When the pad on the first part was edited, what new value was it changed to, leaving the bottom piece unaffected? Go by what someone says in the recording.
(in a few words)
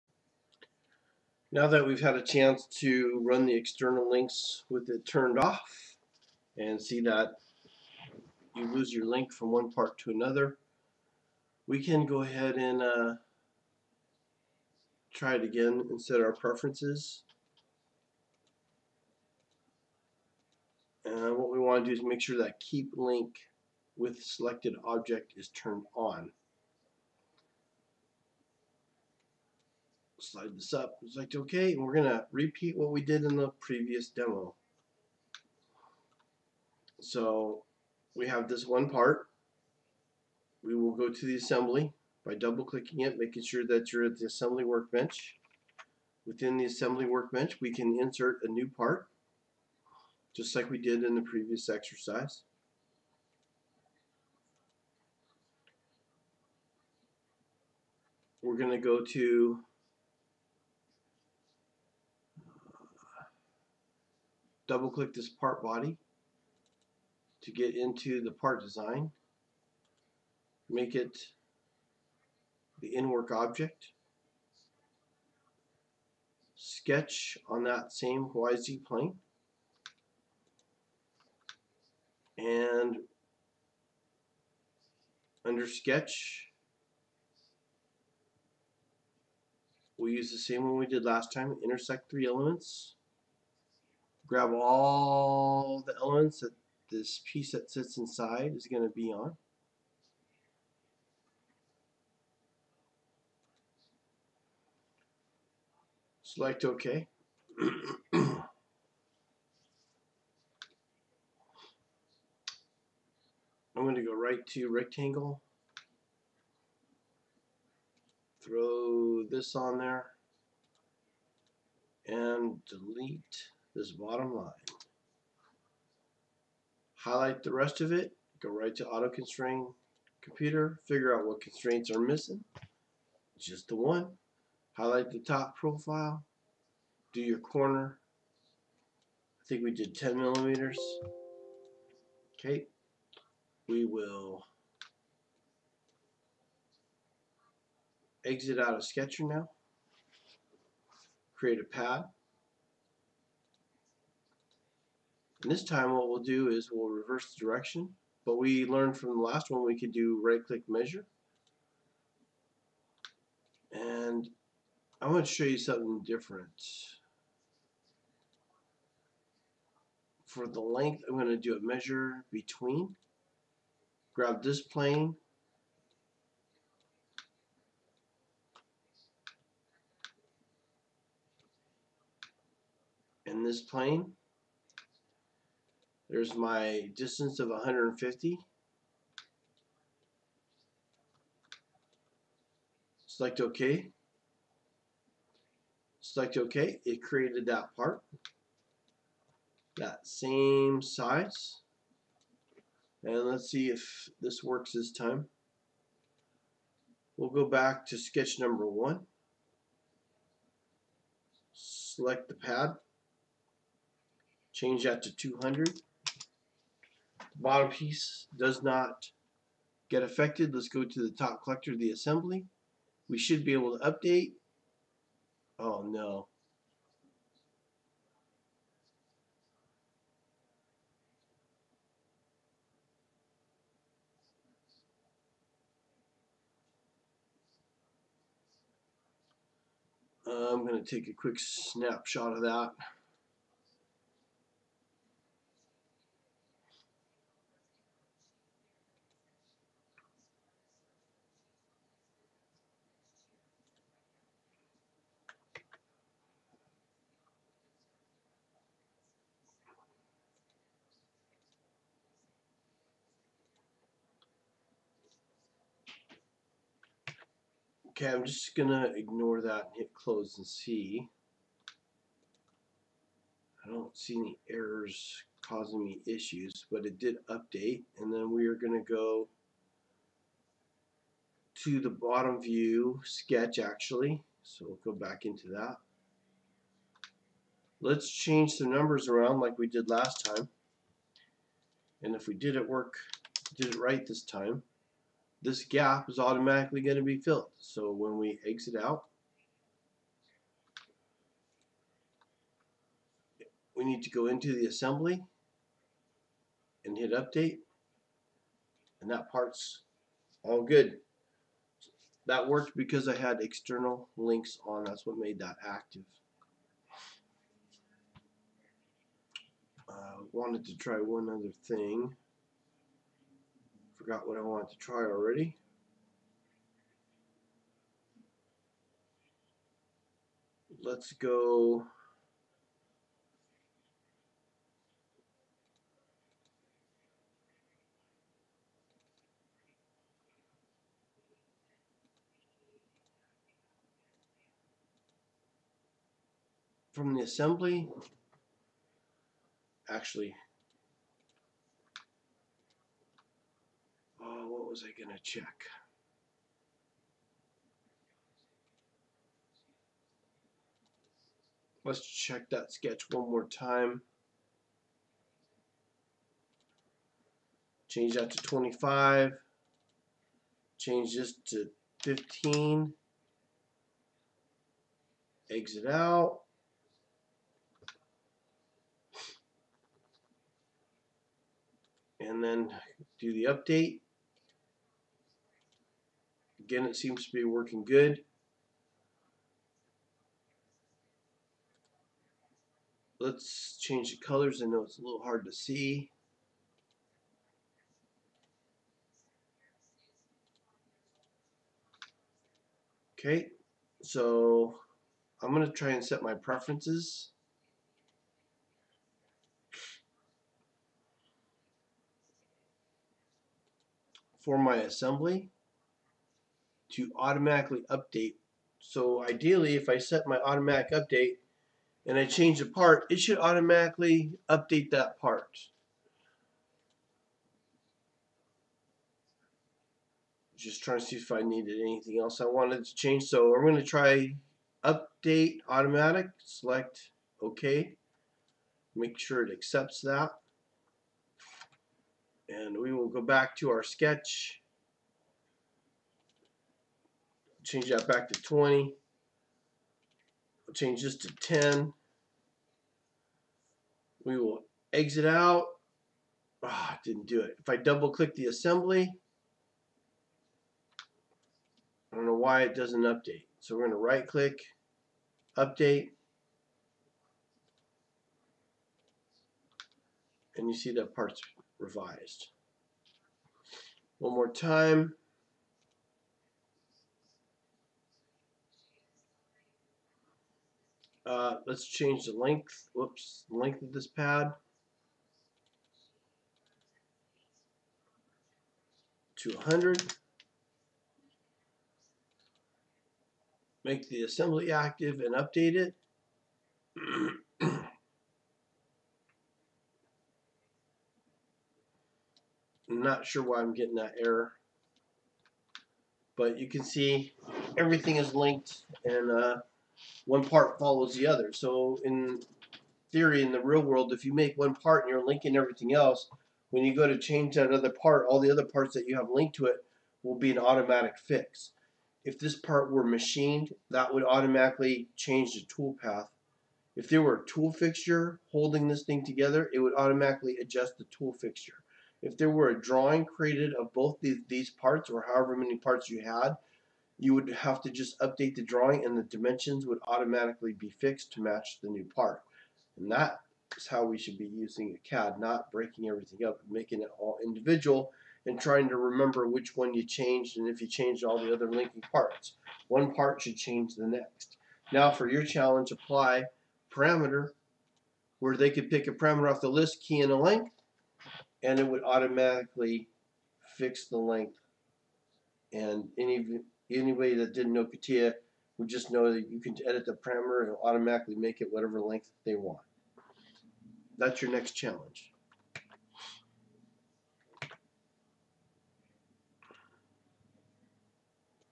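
200.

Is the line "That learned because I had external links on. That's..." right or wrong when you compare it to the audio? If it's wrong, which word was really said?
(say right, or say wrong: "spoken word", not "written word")
wrong: "worked", not "learned".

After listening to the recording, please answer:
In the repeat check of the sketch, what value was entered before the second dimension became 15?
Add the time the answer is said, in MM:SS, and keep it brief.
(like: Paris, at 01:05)
25, at 06:08.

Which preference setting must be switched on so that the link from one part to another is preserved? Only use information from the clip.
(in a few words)
keep link with selected object.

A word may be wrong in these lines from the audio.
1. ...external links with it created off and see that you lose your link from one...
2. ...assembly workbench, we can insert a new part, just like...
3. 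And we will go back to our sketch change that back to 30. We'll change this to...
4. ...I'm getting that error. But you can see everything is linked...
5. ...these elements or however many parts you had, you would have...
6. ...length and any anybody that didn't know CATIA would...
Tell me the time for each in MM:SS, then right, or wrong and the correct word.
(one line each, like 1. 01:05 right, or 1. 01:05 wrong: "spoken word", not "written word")
1. 00:03 wrong: "turned", not "created"
2. 00:46 right
3. 07:22 wrong: "20", not "30"
4. 08:23 right
5. 08:54 wrong: "parts", not "elements"
6. 09:24 right.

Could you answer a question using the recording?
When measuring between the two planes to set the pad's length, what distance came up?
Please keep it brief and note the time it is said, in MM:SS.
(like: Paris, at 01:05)
150, at 03:07.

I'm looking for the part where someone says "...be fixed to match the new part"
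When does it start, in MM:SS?
09:00.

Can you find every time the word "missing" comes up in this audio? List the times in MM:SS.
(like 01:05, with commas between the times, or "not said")
02:11.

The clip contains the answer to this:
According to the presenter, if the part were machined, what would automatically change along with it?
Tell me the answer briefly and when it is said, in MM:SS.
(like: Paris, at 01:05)
tool path, at 08:45.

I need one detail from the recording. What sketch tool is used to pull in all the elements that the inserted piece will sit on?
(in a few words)
intersect 3D elements.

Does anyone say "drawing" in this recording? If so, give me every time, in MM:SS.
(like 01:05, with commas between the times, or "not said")
08:52, 08:58.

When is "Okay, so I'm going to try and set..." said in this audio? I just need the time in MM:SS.
06:43.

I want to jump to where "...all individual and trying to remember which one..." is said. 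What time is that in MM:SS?
09:07.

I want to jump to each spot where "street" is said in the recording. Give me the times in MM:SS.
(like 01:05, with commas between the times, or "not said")
not said.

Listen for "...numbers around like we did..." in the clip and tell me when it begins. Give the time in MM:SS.
04:48.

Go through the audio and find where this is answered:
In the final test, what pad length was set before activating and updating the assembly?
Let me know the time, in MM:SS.
08:09.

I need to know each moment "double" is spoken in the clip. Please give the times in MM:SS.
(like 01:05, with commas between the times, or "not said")
00:42, 01:04, 07:37.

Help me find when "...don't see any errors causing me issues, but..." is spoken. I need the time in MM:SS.
04:33.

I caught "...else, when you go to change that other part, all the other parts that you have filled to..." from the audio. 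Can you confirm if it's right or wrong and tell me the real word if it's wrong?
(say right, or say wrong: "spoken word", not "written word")
wrong: "linked", not "filled".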